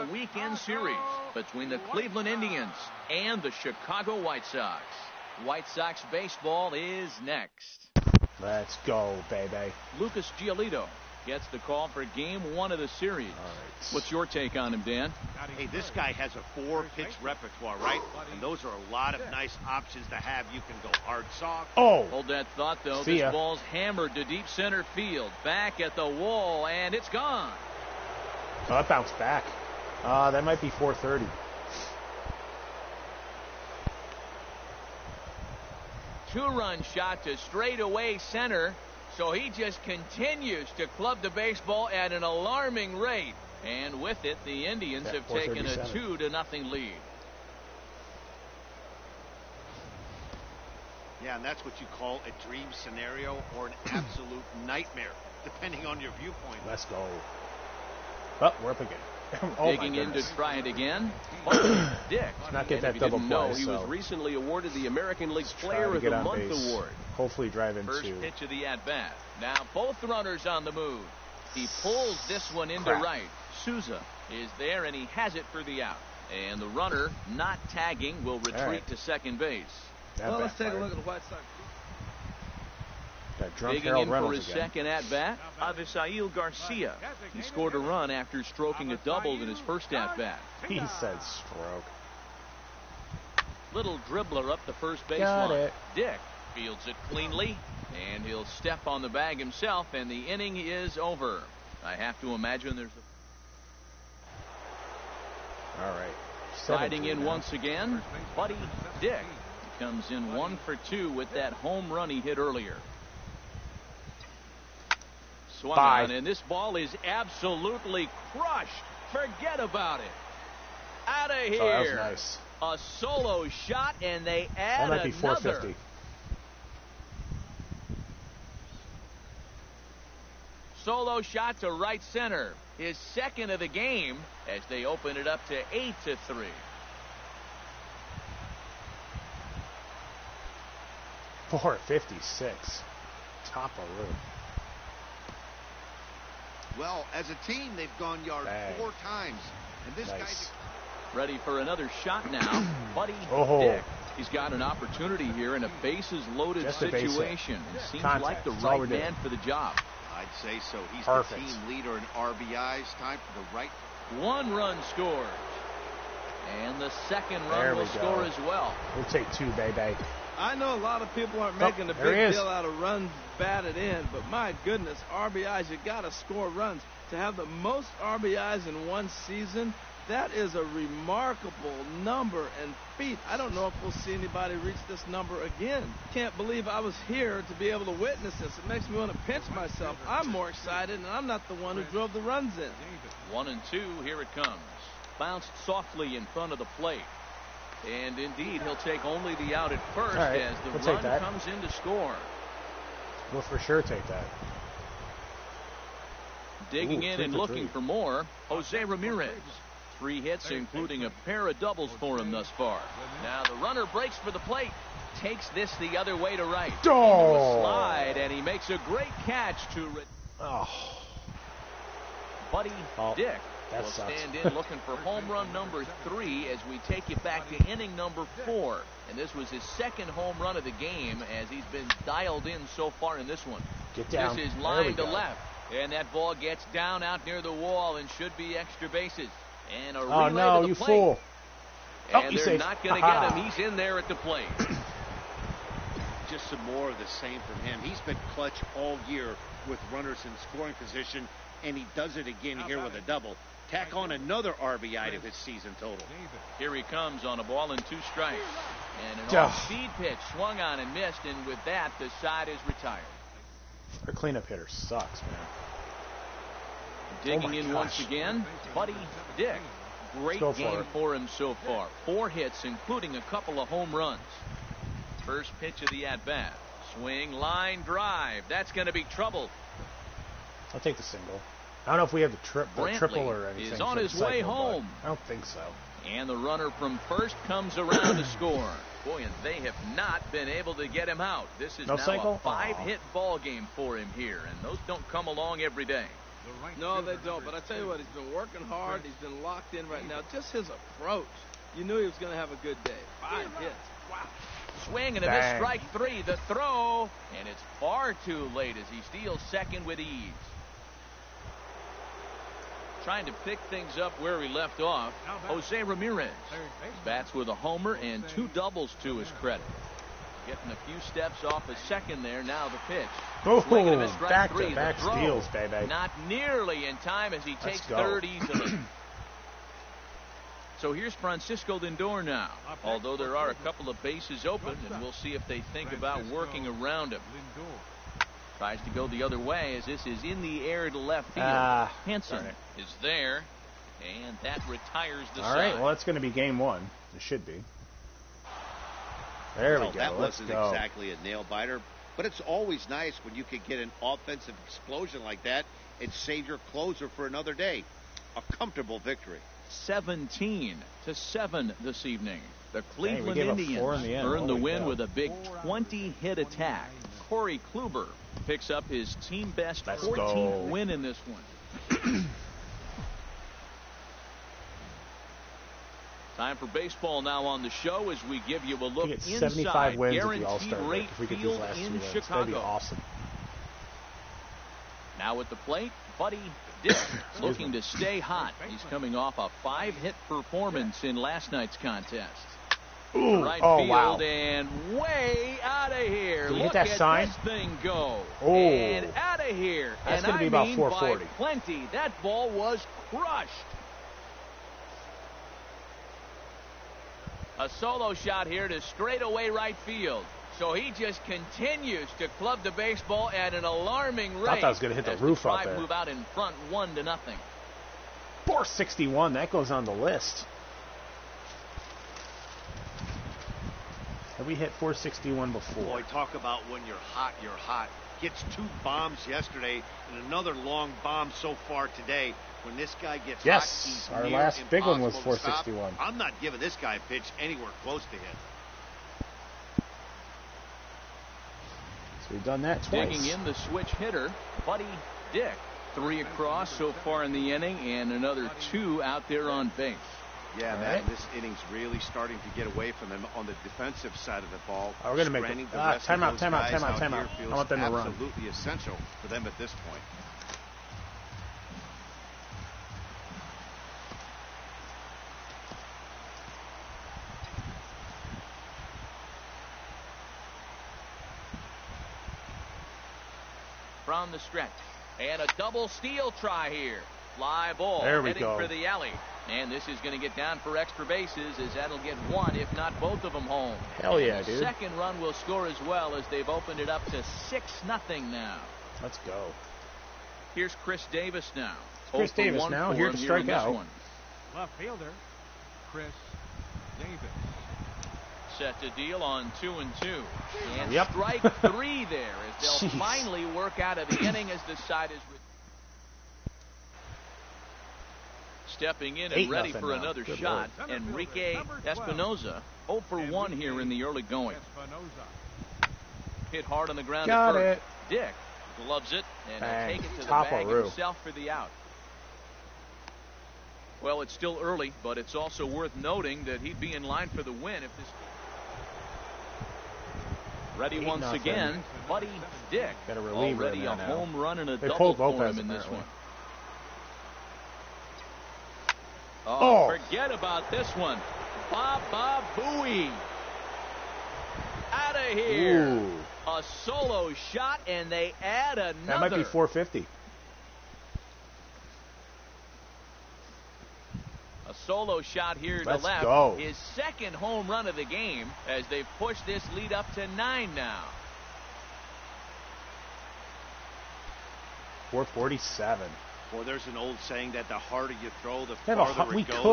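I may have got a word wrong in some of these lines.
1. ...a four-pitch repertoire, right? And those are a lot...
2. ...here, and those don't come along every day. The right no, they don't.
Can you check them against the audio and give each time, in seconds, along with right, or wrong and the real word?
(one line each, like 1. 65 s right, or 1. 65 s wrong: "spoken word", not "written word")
1. 16 s right
2. 294 s right.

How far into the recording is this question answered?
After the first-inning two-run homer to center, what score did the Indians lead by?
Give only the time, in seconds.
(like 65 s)
45 s.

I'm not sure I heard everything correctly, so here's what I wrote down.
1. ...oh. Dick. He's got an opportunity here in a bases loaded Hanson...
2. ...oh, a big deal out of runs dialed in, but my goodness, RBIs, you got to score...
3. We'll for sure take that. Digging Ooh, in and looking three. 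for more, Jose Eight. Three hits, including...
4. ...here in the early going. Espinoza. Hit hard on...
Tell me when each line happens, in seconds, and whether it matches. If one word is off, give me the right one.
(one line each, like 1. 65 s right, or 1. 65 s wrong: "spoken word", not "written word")
1. 153 s wrong: "Just", not "Hanson"
2. 171 s wrong: "batted", not "dialed"
3. 203 s wrong: "Ramirez", not "Eight"
4. 513 s right.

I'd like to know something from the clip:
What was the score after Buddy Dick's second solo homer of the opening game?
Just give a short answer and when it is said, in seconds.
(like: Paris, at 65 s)
8 to 3, at 135 s.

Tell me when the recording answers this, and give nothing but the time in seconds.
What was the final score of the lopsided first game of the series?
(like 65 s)
359 s.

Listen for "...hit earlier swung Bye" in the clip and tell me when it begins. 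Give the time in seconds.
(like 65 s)
112 s.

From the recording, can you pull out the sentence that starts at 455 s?
Oh, we're going to make it.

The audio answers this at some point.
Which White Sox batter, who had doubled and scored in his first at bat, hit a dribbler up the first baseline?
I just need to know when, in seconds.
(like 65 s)
85 s.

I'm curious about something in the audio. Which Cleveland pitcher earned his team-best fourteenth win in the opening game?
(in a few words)
Corey Kluber.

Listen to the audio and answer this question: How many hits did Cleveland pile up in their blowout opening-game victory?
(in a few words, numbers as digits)
20.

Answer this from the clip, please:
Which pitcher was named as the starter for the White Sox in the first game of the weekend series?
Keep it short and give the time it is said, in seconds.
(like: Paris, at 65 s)
Lucas Giolito, at 9 s.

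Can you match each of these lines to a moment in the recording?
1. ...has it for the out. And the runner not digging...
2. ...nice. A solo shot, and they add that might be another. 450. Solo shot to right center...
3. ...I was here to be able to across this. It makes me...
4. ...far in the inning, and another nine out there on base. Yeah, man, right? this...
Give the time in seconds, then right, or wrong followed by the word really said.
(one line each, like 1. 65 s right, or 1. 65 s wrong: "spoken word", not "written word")
1. 75 s wrong: "tagging", not "digging"
2. 121 s right
3. 186 s wrong: "witness", not "across"
4. 446 s wrong: "two", not "nine".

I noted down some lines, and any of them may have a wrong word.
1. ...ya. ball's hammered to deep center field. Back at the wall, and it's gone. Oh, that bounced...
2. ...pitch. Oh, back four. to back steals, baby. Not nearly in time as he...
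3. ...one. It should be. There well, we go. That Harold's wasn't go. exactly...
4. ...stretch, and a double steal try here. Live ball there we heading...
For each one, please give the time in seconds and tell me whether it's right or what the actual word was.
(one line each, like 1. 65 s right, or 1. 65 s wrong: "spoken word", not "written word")
1. 23 s right
2. 322 s wrong: "three", not "four"
3. 346 s wrong: "Let", not "Harold"
4. 474 s right.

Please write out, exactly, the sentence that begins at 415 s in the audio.
move out in front, one to nothing.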